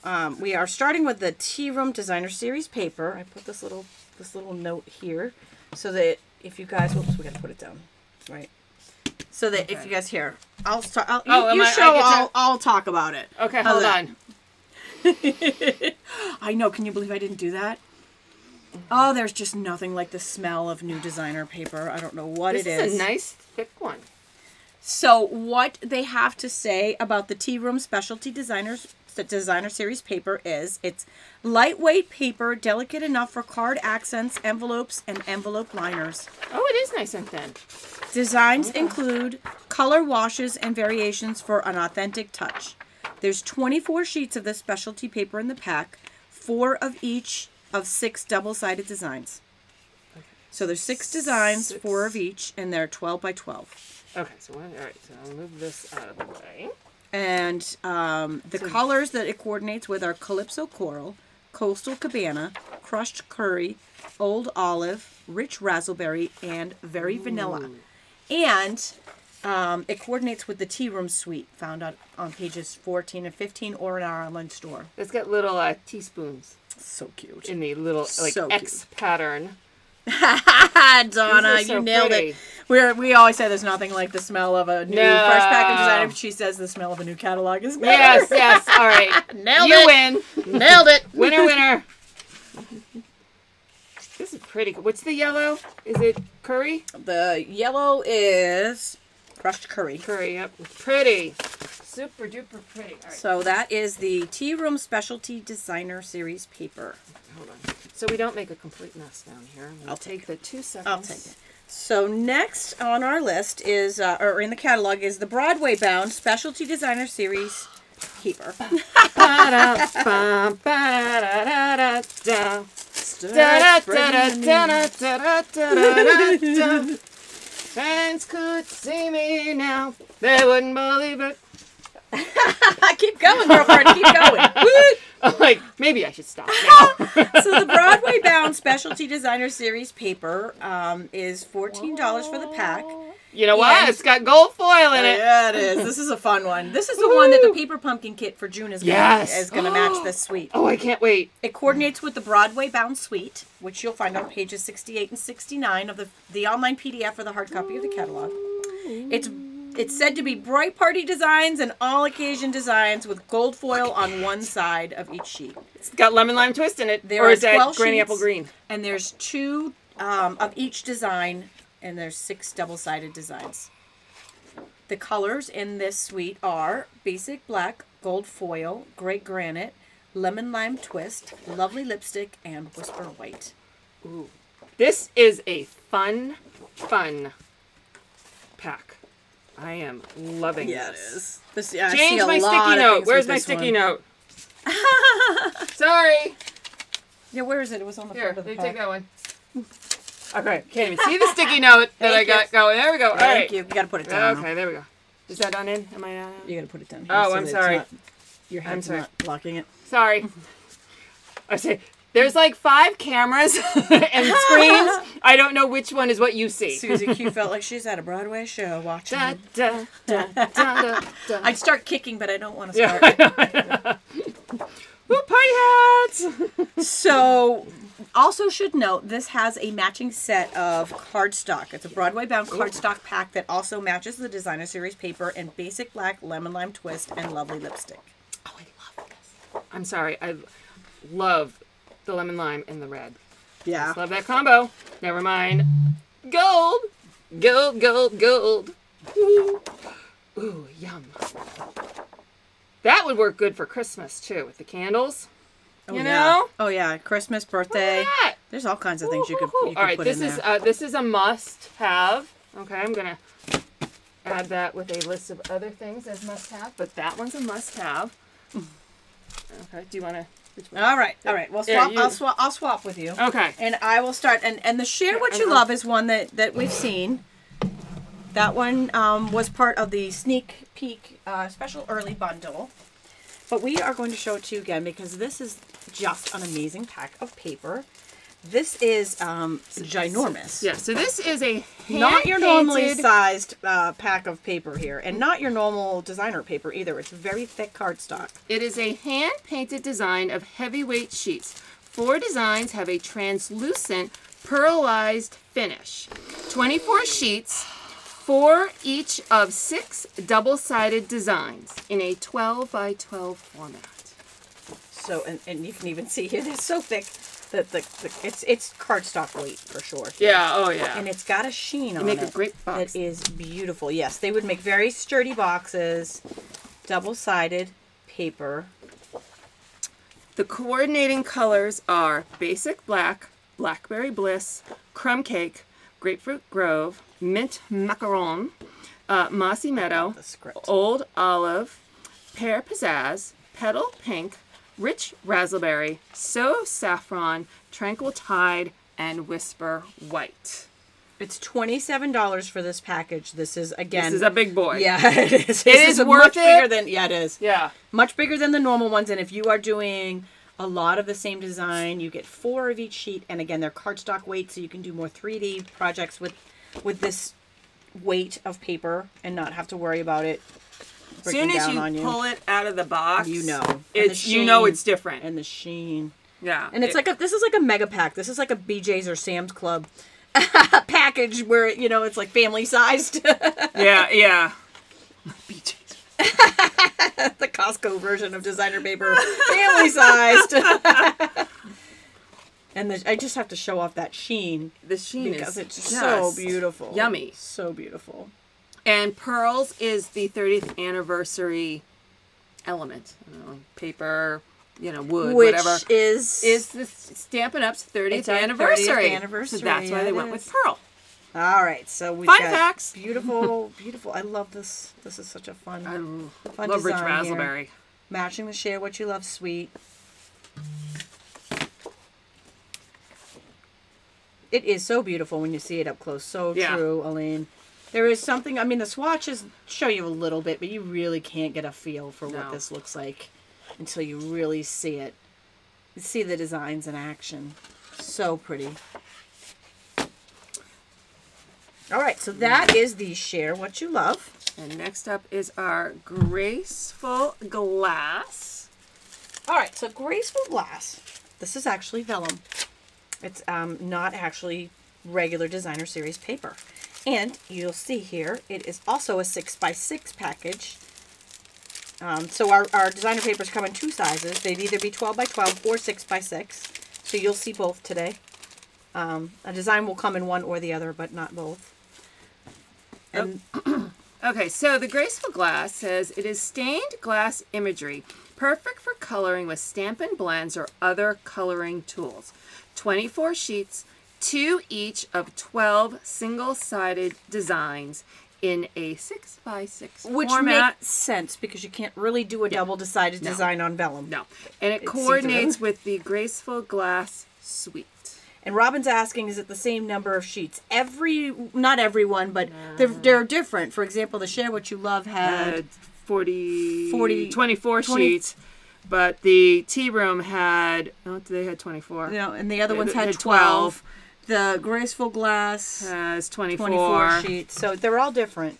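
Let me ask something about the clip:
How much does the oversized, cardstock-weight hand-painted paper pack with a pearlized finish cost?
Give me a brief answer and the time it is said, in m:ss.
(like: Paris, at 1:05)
$27, at 5:51.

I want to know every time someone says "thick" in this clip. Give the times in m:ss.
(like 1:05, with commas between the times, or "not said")
0:23, 4:57, 5:16.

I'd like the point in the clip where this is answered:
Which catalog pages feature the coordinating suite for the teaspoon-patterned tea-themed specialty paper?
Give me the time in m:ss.
1:12.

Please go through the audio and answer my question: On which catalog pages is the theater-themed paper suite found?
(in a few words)
68 and 69.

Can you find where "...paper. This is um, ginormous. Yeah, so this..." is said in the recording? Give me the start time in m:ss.
4:47.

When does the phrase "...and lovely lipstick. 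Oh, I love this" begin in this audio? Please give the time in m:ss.
3:57.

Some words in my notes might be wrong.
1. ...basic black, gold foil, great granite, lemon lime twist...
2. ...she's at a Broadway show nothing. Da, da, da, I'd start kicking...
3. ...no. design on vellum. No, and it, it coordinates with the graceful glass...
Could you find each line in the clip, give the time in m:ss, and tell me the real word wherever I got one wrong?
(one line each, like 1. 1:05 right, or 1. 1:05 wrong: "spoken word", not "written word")
1. 2:57 right
2. 3:37 wrong: "watching", not "nothing"
3. 8:13 right.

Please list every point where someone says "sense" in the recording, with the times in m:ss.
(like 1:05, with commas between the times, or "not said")
8:10.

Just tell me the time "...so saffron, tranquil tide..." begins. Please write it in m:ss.
5:46.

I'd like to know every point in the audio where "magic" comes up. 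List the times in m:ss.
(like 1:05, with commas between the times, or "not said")
not said.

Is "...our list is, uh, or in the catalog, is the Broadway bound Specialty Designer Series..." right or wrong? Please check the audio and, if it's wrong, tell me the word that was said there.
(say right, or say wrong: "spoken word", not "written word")
right.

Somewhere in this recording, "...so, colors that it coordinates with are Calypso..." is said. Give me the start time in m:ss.
0:58.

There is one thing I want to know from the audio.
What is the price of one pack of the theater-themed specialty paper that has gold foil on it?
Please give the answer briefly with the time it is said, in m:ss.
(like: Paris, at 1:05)
$14, at 2:21.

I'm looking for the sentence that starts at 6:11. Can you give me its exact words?
As Soon as you, you, pull it out of the box, you know it's sheen, you know it's different.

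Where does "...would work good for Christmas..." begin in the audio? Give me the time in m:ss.
4:13.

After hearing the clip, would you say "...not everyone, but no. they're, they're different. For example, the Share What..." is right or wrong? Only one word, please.
right.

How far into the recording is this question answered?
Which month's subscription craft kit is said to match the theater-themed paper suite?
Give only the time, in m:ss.
2:28.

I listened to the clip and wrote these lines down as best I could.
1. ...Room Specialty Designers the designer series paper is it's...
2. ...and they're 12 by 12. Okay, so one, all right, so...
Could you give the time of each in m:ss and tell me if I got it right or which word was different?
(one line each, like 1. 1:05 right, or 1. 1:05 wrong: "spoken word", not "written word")
1. 0:27 right
2. 0:52 right.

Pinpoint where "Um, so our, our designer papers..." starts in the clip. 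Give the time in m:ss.
7:42.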